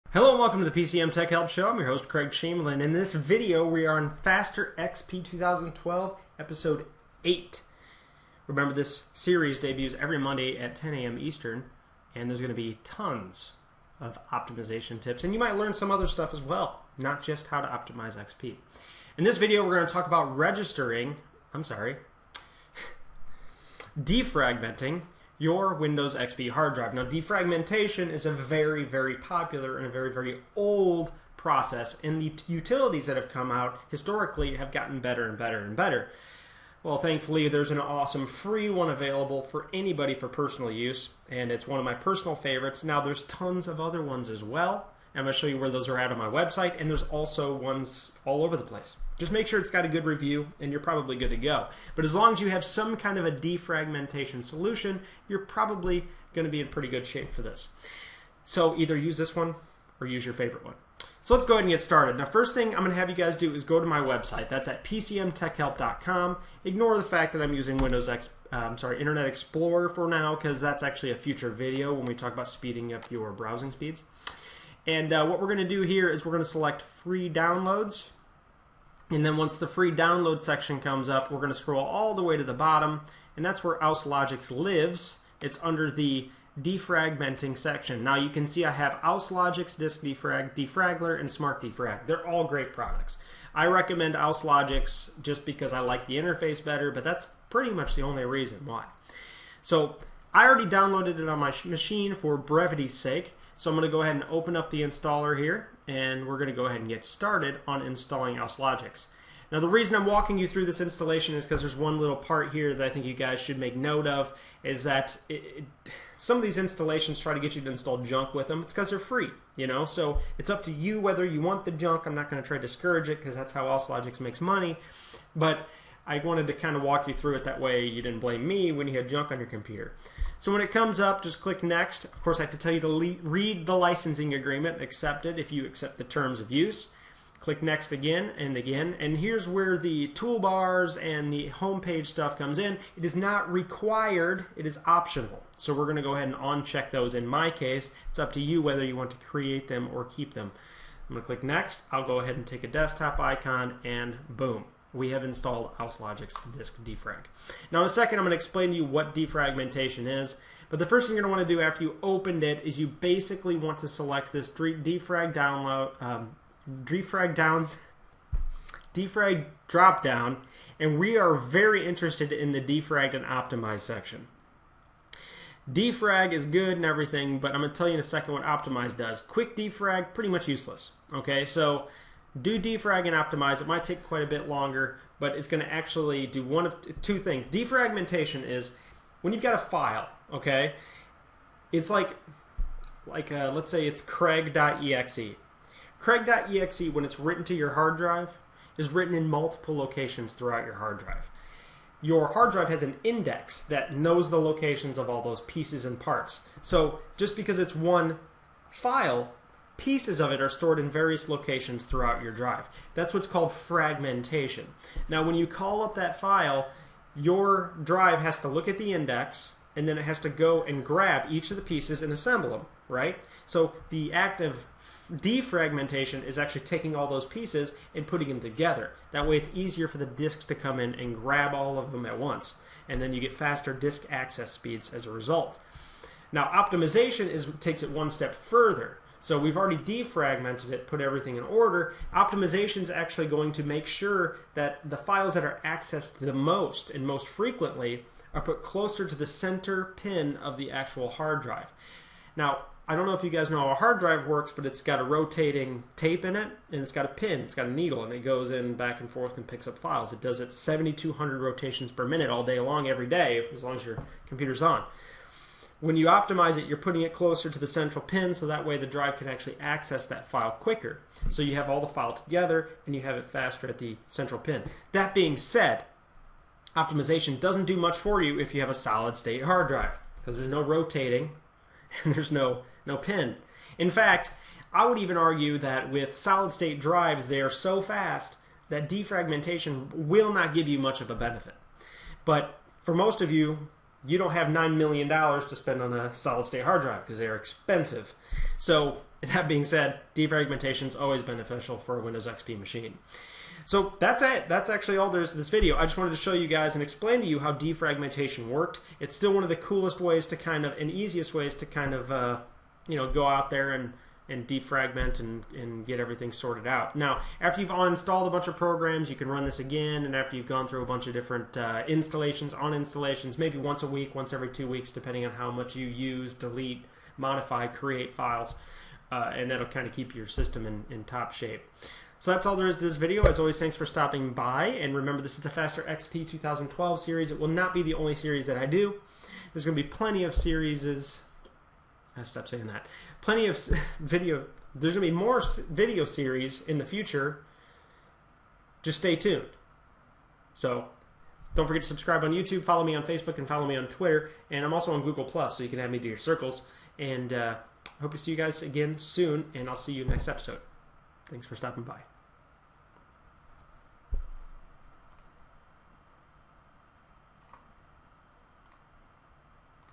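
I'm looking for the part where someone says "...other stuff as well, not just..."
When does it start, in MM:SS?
00:15.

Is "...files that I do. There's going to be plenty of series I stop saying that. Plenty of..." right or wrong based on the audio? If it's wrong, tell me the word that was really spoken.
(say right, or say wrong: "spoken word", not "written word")
wrong: "series", not "files".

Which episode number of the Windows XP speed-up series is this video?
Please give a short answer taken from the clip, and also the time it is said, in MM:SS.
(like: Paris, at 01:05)
8, at 00:06.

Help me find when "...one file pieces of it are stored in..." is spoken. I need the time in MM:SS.
03:27.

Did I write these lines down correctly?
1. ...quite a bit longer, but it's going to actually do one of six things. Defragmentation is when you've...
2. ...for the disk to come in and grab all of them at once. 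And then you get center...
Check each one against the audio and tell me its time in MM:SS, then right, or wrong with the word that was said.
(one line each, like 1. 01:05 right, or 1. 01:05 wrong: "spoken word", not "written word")
1. 03:04 wrong: "two", not "six"
2. 03:49 wrong: "faster", not "center".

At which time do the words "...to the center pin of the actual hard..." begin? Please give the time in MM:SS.
04:09.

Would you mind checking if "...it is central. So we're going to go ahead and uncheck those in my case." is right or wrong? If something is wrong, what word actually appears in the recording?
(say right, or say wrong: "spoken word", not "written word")
wrong: "optional", not "central".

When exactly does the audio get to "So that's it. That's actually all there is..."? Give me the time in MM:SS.
05:03.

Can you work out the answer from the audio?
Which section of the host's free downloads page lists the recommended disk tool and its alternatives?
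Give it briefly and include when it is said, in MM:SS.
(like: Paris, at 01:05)
defragmenting section, at 01:26.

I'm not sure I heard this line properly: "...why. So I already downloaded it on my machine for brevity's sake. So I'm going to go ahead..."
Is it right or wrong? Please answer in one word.
right.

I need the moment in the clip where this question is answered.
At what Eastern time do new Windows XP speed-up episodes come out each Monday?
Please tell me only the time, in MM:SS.
00:10.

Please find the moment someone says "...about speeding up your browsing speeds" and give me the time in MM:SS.
01:12.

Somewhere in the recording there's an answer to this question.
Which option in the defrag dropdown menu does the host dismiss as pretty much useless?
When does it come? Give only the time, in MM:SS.
02:59.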